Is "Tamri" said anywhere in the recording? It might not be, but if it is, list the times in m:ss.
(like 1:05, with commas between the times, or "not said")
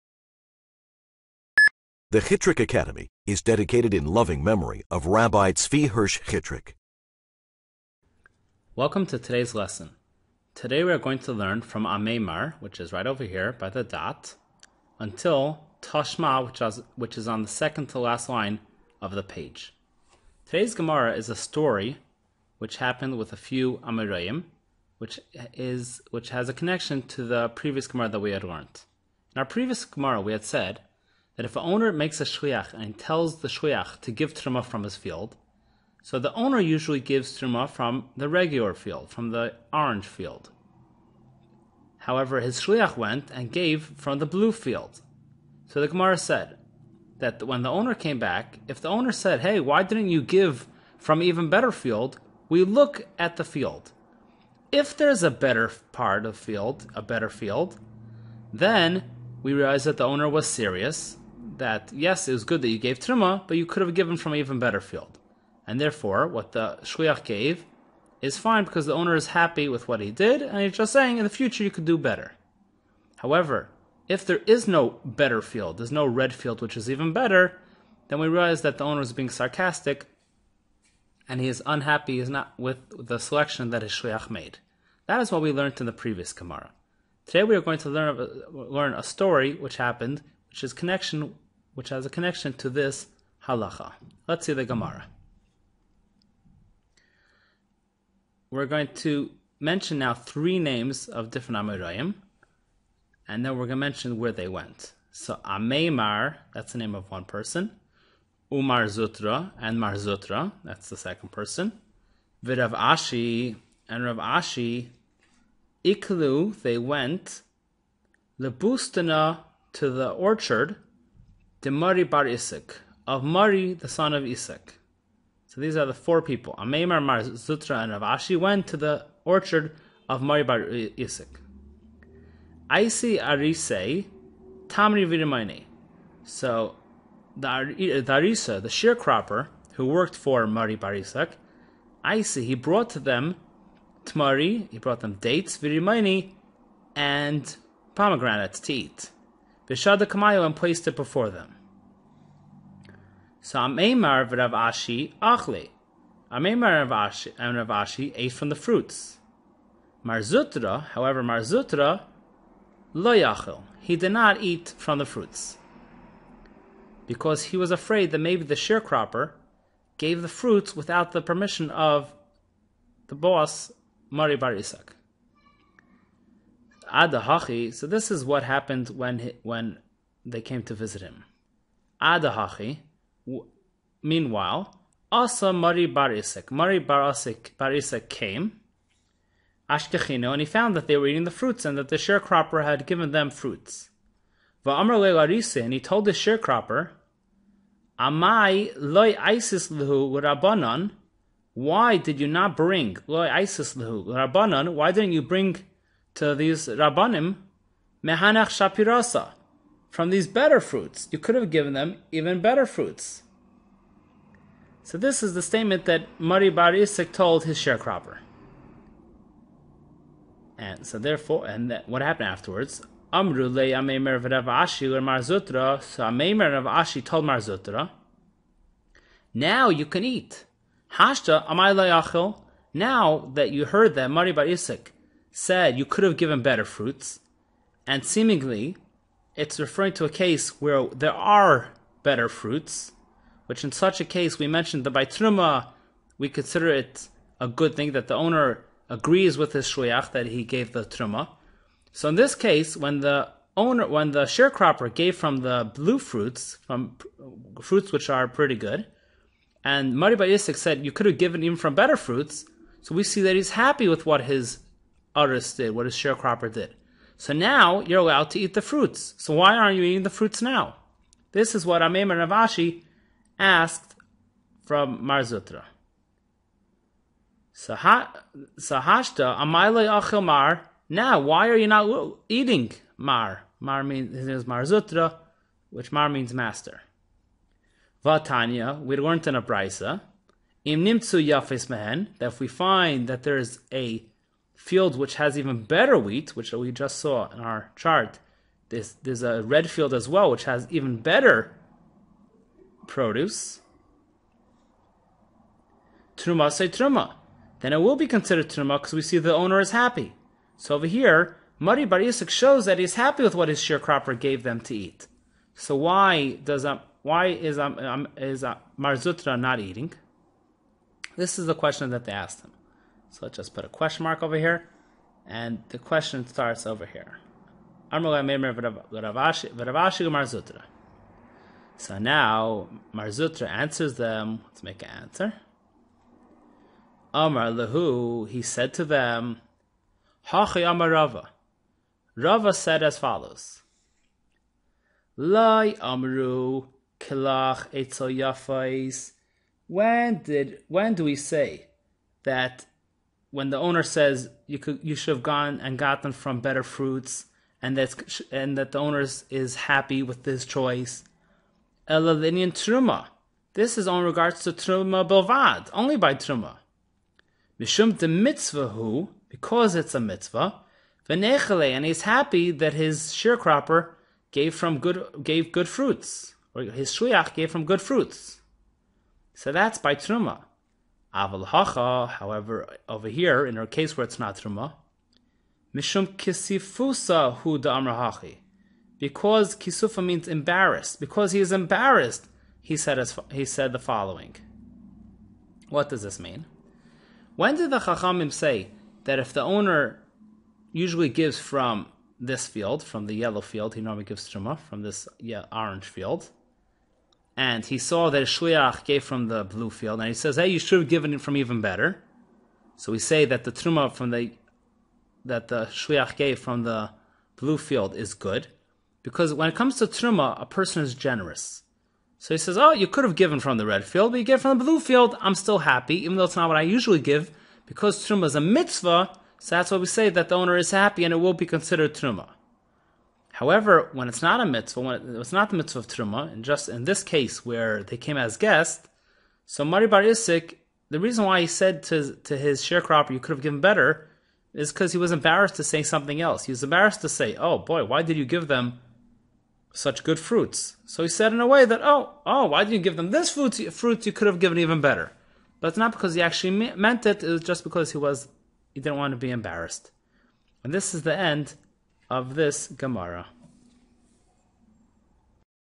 2:14.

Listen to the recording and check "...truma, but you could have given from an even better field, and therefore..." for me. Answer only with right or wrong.
right.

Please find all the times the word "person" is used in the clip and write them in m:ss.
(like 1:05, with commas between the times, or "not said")
1:47, 1:51, 7:00.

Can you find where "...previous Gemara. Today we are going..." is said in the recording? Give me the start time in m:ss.
1:26.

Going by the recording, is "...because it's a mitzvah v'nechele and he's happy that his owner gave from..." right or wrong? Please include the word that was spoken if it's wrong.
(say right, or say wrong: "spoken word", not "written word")
wrong: "sharecropper", not "owner".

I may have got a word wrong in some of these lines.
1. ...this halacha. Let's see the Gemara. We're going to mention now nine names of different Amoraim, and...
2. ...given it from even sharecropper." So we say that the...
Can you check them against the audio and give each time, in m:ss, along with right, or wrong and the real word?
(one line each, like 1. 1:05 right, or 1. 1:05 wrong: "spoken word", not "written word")
1. 1:32 wrong: "three", not "nine"
2. 6:50 wrong: "better", not "sharecropper".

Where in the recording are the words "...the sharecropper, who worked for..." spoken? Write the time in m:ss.
2:18.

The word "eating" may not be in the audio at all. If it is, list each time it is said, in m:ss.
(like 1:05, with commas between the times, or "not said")
3:11, 4:29, 4:42, 5:19.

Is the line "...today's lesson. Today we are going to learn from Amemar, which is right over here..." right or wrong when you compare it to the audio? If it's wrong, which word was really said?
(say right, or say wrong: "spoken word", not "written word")
right.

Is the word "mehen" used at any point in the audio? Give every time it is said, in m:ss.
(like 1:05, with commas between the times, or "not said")
4:51.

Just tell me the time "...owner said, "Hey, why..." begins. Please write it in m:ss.
0:48.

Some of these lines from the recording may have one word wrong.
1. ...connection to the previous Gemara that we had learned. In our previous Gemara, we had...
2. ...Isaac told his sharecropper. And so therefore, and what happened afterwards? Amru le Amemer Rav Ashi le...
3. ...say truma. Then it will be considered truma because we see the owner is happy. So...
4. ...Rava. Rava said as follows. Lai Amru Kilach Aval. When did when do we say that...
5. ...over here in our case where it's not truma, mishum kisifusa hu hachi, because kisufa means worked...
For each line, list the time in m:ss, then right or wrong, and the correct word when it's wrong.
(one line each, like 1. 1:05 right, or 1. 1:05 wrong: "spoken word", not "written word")
1. 0:26 right
2. 3:36 right
3. 5:06 right
4. 5:40 wrong: "Yafais", not "Aval"
5. 6:22 wrong: "embarrassed", not "worked".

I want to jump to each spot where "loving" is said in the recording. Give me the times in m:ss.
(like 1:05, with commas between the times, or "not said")
0:04.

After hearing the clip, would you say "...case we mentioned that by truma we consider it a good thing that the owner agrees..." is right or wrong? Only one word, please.
right.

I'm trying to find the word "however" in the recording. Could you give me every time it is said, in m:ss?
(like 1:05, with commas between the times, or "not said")
0:41, 1:13, 2:40, 6:22, 7:13.